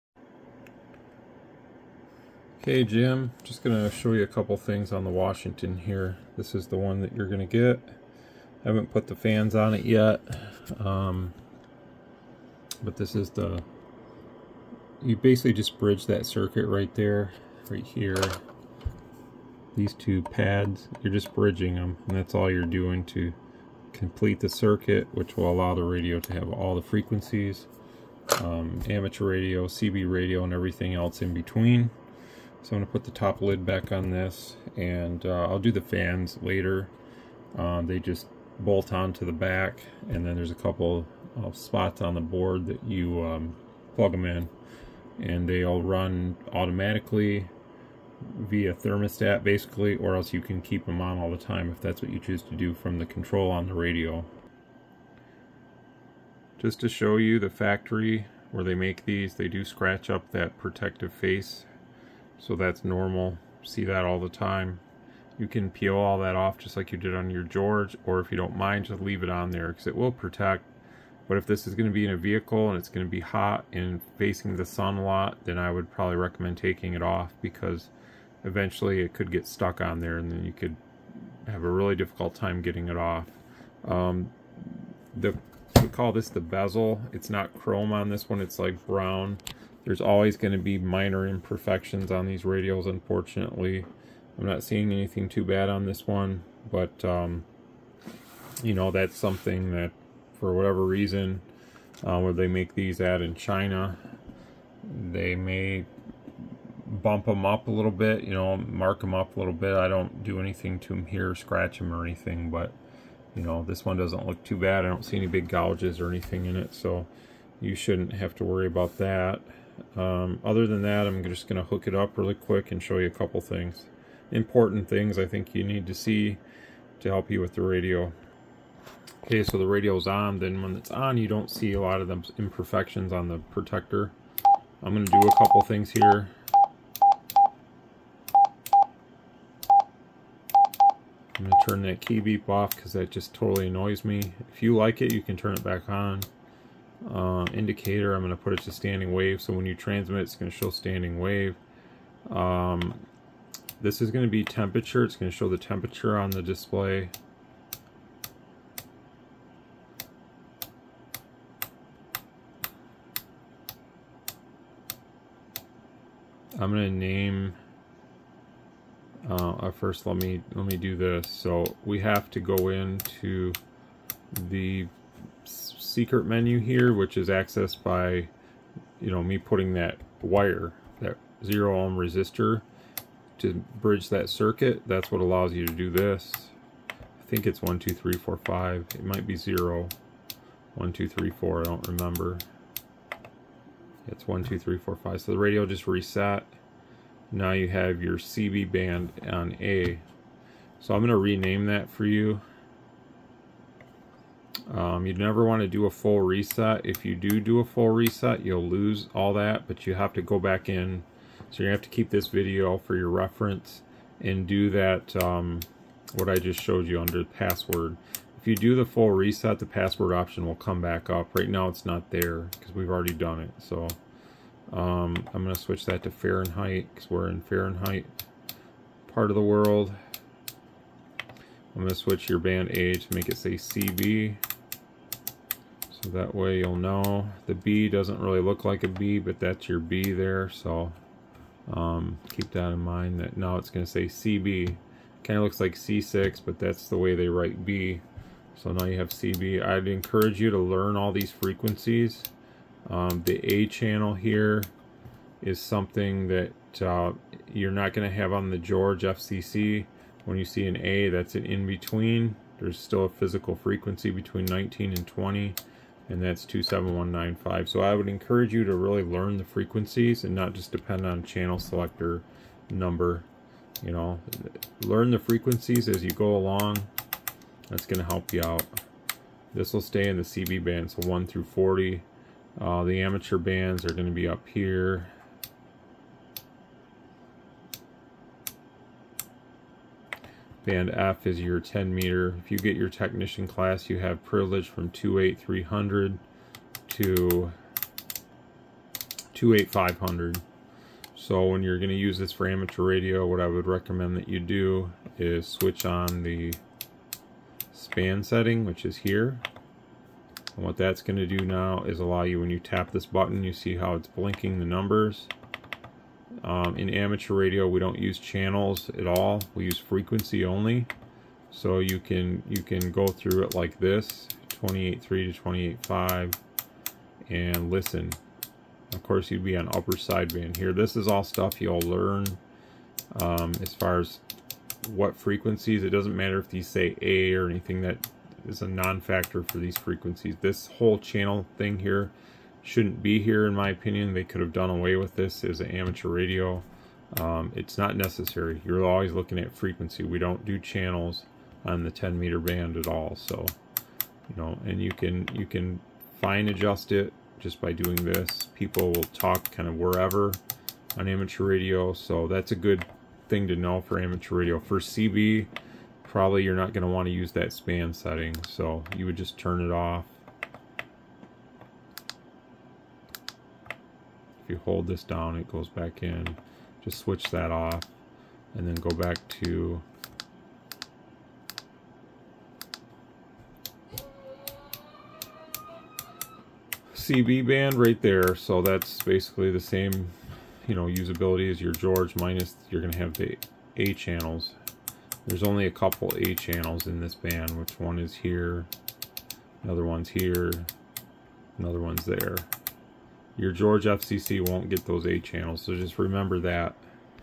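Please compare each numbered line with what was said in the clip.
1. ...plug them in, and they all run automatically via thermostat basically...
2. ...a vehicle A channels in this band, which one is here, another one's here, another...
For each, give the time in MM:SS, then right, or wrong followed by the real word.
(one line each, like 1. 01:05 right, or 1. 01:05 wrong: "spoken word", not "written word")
1. 00:43 right
2. 06:35 wrong: "couple", not "vehicle".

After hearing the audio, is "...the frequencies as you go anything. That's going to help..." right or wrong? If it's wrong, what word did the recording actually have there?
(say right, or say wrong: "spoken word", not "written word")
wrong: "along", not "anything".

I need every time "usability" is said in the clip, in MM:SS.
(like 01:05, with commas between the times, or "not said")
06:30.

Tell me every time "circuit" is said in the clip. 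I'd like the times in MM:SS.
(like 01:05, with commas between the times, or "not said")
00:16, 00:24, 03:04.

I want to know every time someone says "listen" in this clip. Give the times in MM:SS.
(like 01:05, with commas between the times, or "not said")
05:27.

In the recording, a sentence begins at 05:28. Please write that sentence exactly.
Of course, you'd be on upper sideband here.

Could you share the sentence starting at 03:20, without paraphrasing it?
So I'm gonna rename that for you.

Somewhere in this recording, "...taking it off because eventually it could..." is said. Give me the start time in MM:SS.
01:16.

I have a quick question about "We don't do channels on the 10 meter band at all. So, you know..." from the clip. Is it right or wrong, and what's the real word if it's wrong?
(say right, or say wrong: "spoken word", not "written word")
right.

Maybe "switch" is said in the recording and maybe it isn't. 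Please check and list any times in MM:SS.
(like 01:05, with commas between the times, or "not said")
03:45, 03:51, 05:05, 06:16.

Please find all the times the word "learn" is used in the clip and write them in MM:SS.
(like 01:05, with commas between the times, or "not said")
04:10, 04:29, 04:34, 05:31.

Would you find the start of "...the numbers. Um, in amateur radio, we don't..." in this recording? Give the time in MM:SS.
05:14.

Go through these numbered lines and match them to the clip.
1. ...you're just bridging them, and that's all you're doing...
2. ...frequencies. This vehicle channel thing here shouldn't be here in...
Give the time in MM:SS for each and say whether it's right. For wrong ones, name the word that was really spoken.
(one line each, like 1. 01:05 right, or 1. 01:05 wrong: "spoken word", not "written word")
1. 00:21 right
2. 05:39 wrong: "whole", not "vehicle".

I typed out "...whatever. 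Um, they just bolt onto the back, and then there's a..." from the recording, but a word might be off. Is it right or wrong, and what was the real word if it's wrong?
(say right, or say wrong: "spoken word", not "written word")
wrong: "later", not "whatever".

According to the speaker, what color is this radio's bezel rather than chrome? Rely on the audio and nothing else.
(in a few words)
Brown.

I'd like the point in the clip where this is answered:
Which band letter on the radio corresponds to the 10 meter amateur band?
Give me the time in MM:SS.
04:50.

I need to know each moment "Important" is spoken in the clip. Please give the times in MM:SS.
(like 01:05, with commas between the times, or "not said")
02:04.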